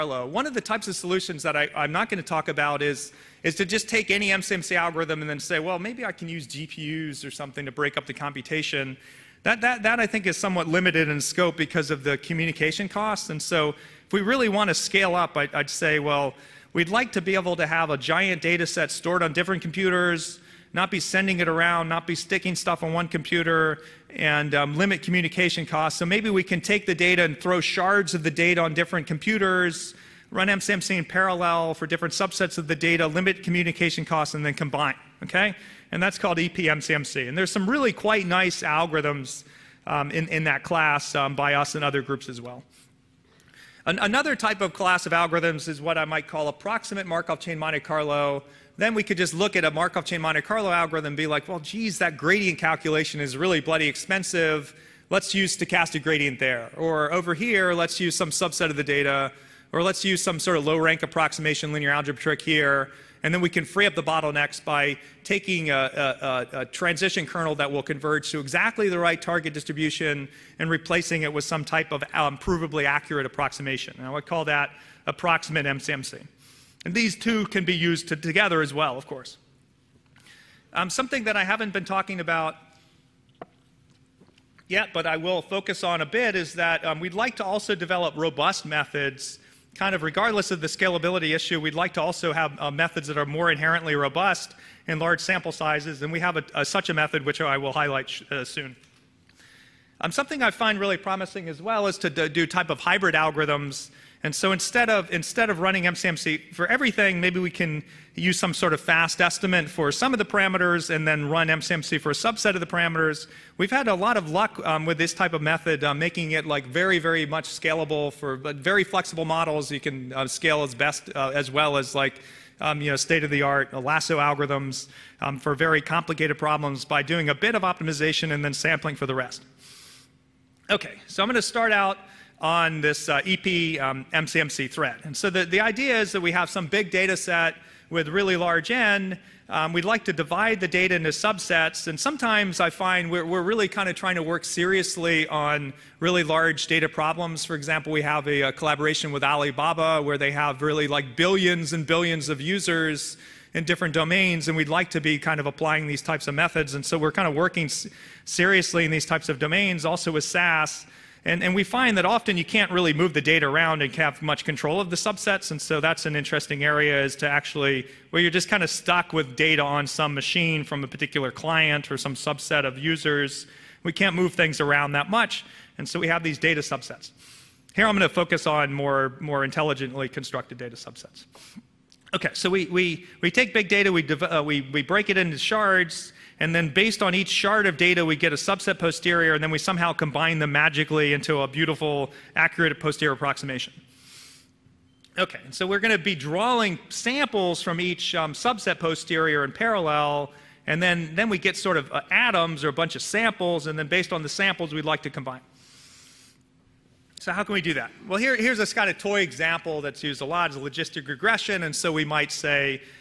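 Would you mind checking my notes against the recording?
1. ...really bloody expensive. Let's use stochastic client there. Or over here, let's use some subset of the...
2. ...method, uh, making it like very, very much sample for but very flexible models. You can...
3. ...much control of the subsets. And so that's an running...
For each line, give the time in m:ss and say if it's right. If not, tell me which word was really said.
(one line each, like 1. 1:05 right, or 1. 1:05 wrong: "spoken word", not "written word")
1. 0:53 wrong: "gradient", not "client"
2. 1:55 wrong: "scalable", not "sample"
3. 2:44 wrong: "interesting", not "running".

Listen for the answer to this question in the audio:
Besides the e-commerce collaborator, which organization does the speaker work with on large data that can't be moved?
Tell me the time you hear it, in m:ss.
2:40.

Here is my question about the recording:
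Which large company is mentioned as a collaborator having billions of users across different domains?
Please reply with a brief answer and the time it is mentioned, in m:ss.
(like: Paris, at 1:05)
Alibaba, at 2:29.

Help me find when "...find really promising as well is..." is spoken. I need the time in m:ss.
1:40.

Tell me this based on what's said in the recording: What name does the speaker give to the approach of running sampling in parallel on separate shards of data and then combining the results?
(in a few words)
EPMCMC.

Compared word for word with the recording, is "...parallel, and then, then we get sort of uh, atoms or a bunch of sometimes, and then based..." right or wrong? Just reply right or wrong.
wrong.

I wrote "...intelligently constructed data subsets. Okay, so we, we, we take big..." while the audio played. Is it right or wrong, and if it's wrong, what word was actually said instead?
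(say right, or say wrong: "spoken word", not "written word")
right.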